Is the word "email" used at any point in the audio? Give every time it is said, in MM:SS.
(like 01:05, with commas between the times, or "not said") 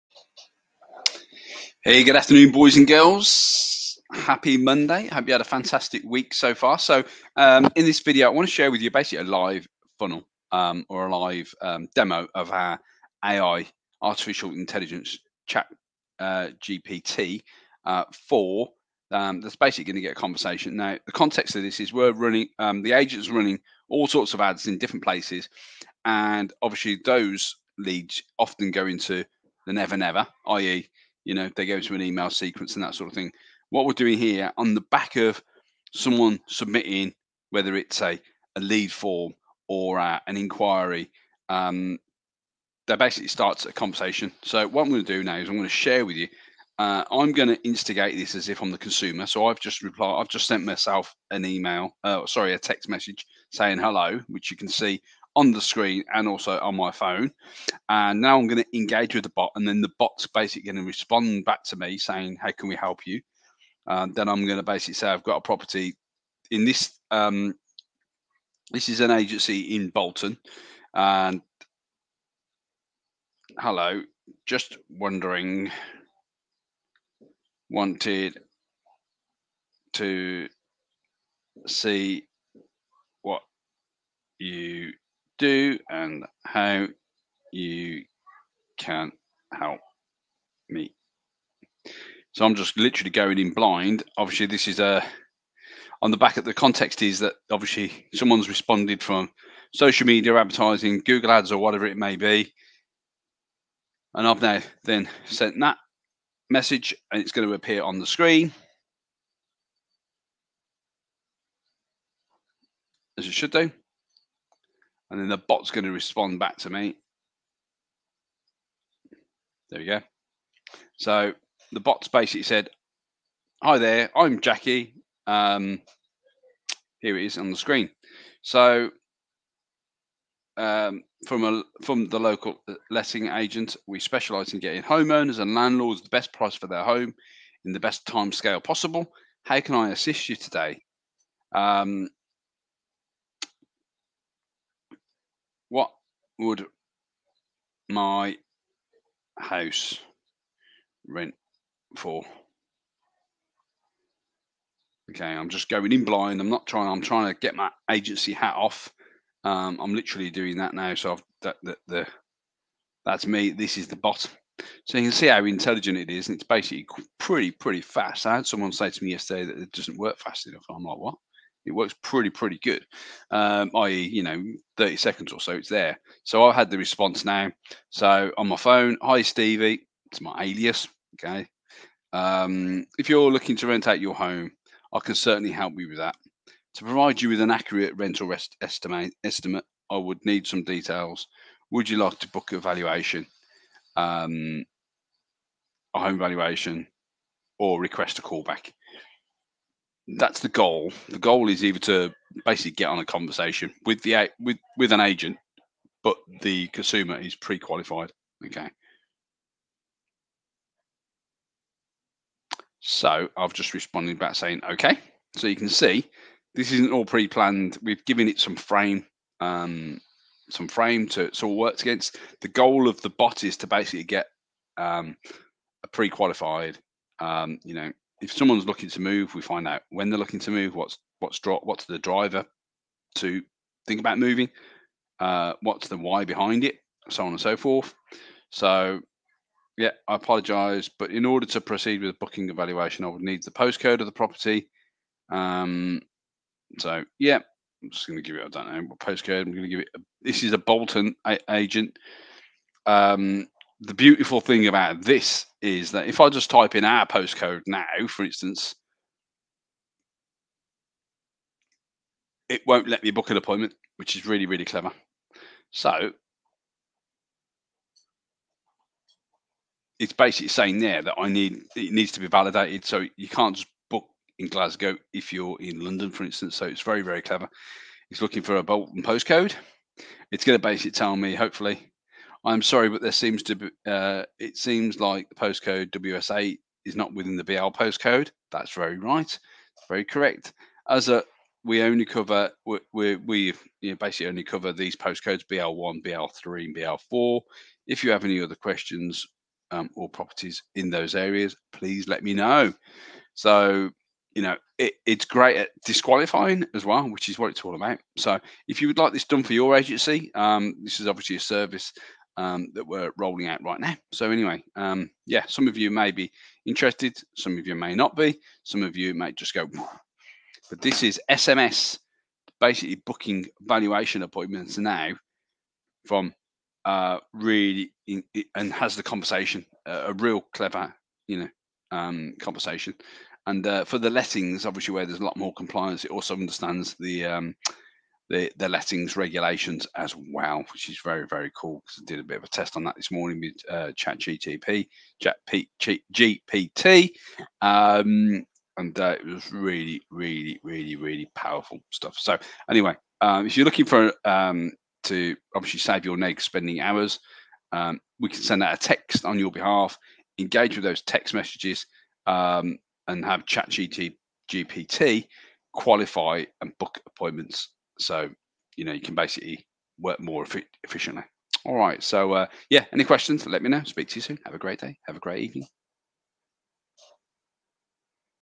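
00:32, 00:51.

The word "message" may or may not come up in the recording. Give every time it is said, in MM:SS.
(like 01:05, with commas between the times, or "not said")
00:52, 01:46, 06:01.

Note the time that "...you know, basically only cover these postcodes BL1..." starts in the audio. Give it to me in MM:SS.
04:53.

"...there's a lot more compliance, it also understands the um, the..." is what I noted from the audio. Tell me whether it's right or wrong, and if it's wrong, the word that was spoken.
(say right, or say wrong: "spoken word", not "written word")
right.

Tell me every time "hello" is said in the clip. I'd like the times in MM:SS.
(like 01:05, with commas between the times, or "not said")
00:53, 01:13.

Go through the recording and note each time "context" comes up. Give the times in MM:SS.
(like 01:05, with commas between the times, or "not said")
00:21, 01:36.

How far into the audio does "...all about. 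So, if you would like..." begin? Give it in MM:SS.
05:07.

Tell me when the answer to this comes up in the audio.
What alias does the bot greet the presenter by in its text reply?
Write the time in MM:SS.
02:59.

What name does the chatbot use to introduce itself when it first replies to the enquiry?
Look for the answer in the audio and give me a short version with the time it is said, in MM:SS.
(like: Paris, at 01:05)
Jackie, at 02:04.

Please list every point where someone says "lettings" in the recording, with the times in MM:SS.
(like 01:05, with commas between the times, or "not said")
02:12, 05:34, 05:38.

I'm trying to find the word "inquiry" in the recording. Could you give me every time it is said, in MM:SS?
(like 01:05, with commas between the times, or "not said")
00:40.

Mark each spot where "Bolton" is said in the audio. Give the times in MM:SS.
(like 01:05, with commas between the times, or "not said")
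01:09, 04:10, 04:38.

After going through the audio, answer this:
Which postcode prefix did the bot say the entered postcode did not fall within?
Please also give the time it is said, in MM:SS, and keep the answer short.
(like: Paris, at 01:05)
BL, at 04:47.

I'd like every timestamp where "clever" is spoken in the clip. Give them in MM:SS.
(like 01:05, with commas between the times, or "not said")
04:24, 04:37, 05:30.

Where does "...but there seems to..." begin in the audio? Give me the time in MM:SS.
04:42.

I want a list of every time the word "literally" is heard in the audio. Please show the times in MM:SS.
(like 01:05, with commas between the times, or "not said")
01:32, 02:39.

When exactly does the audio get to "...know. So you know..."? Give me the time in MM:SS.
05:02.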